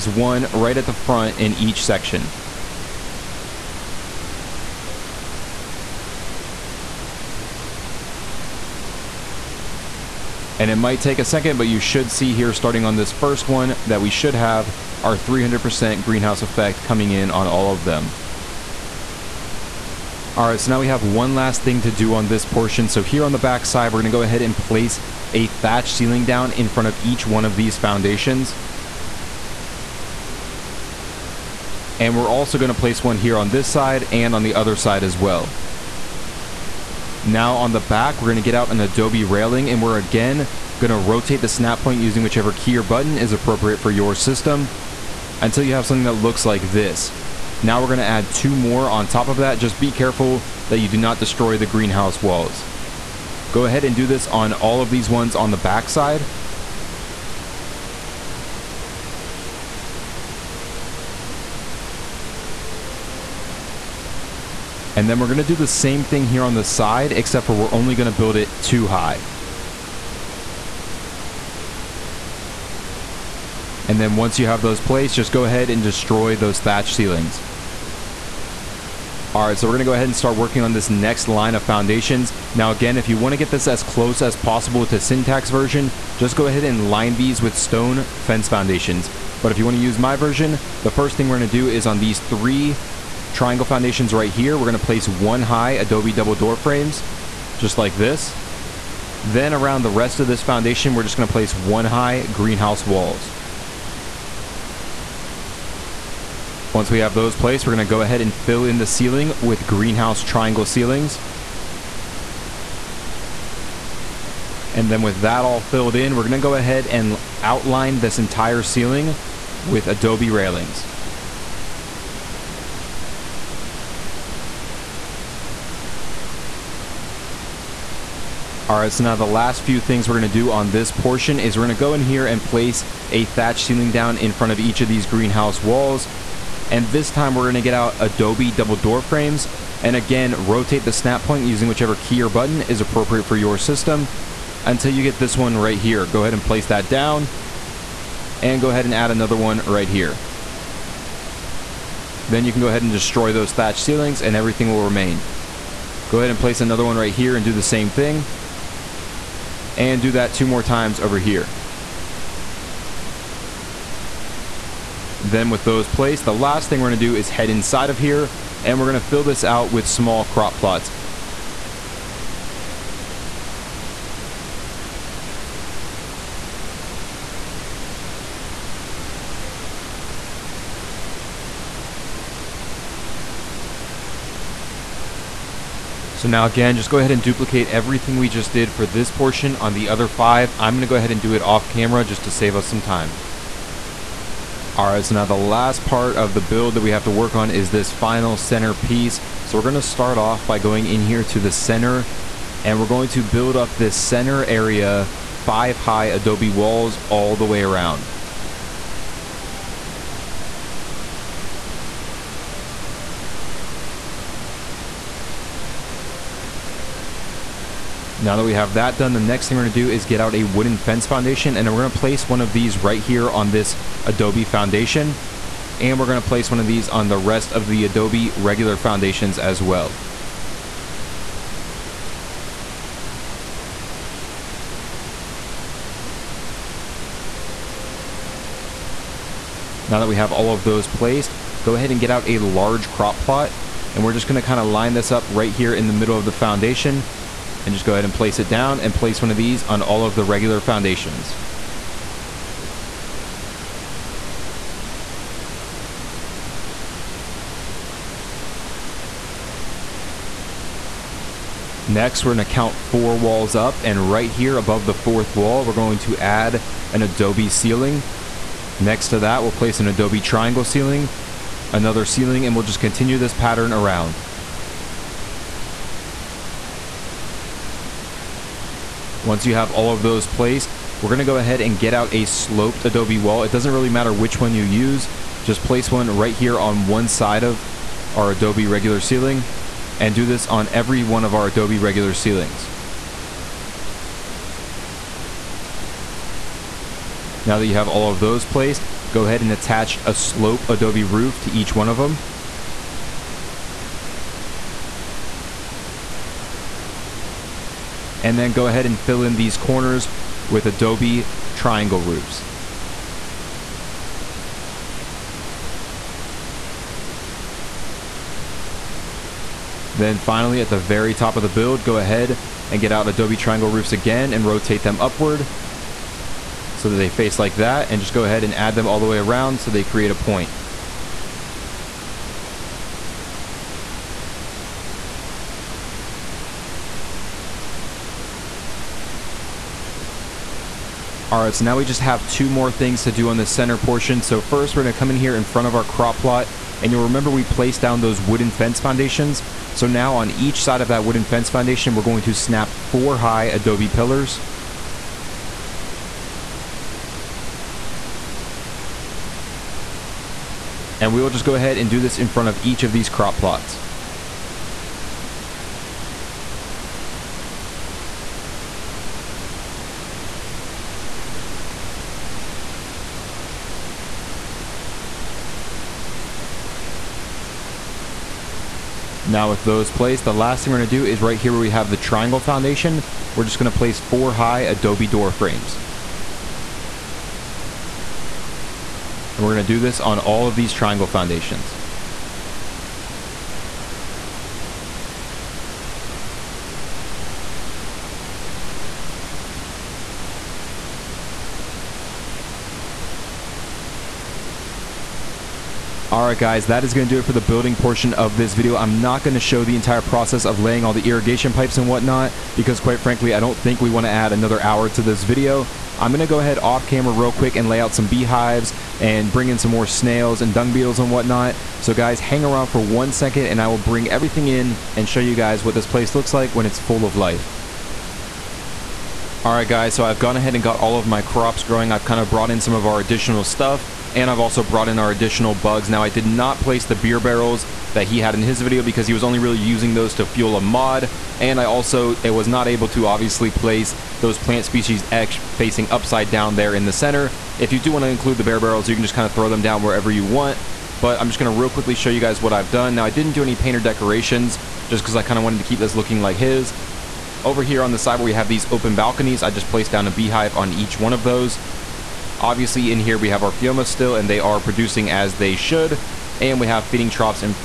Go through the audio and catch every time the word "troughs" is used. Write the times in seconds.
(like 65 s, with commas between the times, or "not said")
467 s.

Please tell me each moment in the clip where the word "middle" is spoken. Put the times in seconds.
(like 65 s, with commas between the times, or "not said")
245 s.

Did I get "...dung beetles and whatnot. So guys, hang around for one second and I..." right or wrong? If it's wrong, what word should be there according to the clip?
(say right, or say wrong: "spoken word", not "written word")
right.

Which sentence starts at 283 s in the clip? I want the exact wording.
It doesn't really matter which one you use.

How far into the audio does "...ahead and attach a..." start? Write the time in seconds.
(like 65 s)
299 s.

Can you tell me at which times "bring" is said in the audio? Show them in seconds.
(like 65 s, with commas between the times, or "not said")
419 s, 423 s.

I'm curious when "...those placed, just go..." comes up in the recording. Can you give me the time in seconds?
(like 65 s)
74 s.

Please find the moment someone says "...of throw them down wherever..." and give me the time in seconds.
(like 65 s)
449 s.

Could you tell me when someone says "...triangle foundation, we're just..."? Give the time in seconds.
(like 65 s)
381 s.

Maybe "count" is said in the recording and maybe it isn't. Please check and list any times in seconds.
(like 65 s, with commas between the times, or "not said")
262 s.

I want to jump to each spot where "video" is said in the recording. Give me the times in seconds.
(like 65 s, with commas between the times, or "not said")
408 s, 415 s, 438 s.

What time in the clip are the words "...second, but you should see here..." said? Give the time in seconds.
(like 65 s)
11 s.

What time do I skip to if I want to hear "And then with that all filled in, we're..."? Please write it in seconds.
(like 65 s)
114 s.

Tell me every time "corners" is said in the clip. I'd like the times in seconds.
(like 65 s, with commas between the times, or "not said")
309 s.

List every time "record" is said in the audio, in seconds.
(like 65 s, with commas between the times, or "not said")
not said.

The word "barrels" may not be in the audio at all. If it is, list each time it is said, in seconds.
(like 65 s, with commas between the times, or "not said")
437 s, 448 s.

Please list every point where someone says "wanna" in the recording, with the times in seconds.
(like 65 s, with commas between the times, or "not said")
83 s, 89 s.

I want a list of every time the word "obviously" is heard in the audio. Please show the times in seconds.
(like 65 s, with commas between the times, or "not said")
443 s, 462 s.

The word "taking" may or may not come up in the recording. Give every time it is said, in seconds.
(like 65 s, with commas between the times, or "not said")
not said.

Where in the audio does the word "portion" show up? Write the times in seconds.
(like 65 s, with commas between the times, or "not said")
22 s, 130 s, 189 s, 343 s, 407 s.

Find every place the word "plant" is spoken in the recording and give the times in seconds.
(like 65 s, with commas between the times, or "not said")
444 s.